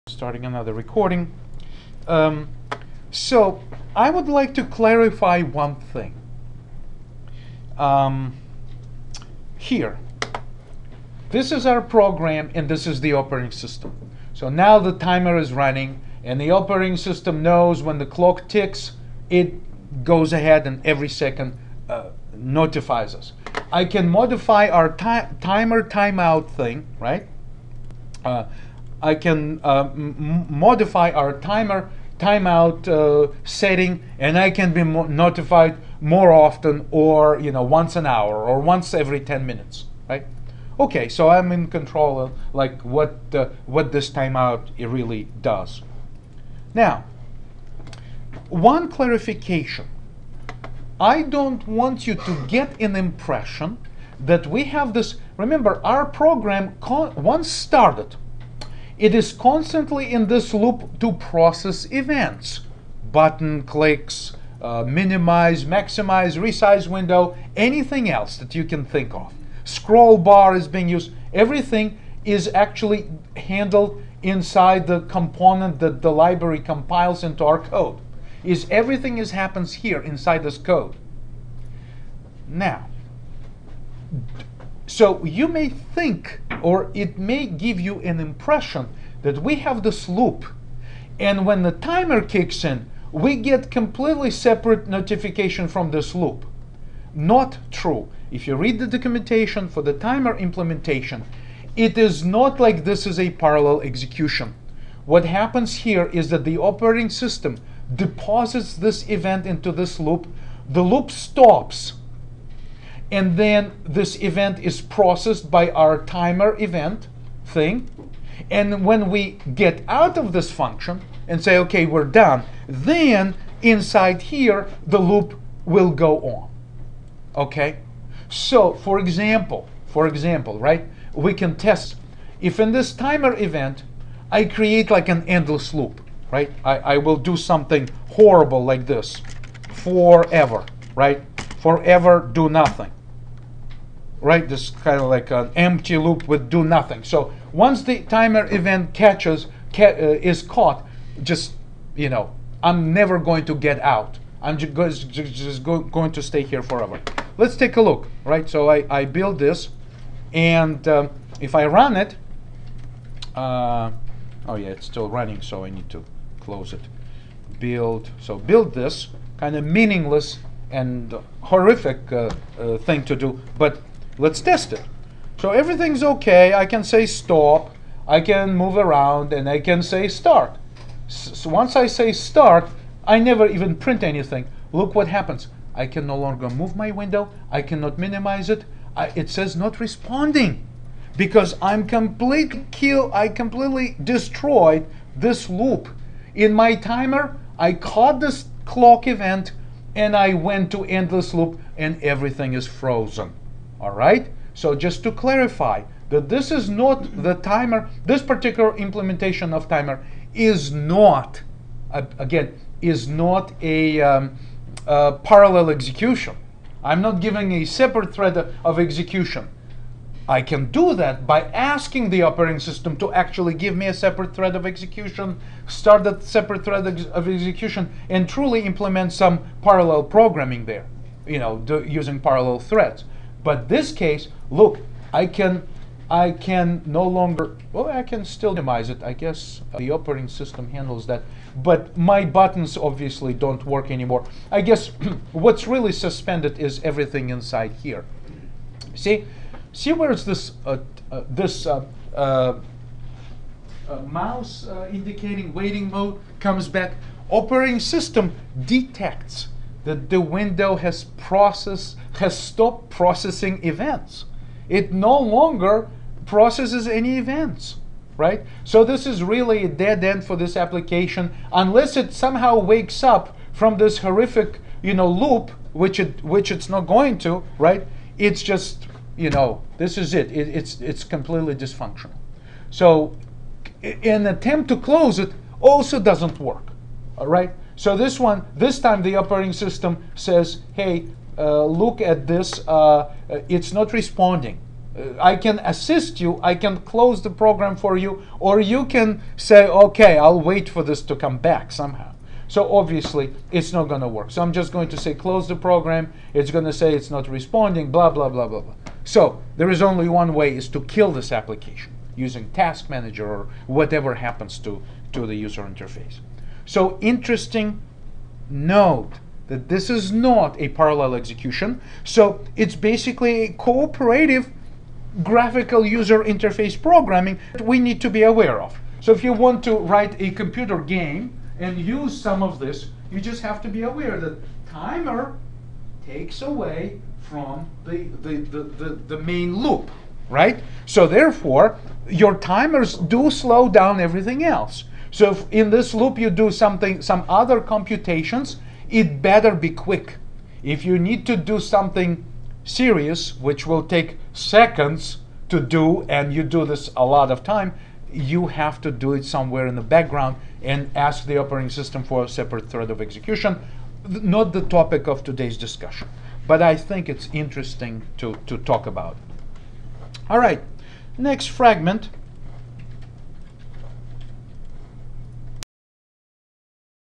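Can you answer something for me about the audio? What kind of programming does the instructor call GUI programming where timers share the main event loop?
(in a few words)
Cooperative.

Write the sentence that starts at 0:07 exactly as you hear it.
Um, here, this is our program and this is the operating system.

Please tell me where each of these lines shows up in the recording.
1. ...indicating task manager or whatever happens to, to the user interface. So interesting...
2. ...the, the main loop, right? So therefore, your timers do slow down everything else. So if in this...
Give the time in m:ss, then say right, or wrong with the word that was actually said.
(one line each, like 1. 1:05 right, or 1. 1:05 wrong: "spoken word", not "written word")
1. 5:12 wrong: "using", not "indicating"
2. 5:38 right.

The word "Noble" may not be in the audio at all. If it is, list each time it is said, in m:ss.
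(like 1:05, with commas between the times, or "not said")
not said.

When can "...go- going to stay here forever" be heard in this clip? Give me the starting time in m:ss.
2:35.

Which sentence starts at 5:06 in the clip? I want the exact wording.
It's going to say it's not responding, blah, blah, blah, blah, blah.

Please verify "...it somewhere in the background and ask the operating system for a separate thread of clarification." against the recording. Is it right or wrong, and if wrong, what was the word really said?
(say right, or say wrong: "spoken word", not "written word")
wrong: "execution", not "clarification".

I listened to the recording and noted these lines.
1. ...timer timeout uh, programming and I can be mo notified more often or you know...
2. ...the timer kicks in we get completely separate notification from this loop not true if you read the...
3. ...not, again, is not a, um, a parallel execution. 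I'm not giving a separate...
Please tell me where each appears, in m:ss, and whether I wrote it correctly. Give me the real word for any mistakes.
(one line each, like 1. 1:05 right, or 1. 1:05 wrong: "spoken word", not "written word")
1. 0:31 wrong: "setting", not "programming"
2. 1:31 right
3. 3:30 right.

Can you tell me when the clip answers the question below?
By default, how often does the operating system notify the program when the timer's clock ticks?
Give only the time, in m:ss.
0:20.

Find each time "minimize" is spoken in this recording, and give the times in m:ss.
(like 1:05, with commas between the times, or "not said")
1:04, 3:07, 3:58.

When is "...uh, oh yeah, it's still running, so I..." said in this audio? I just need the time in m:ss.
2:43.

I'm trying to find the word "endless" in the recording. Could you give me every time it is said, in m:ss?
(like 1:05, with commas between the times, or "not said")
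2:15, 3:20.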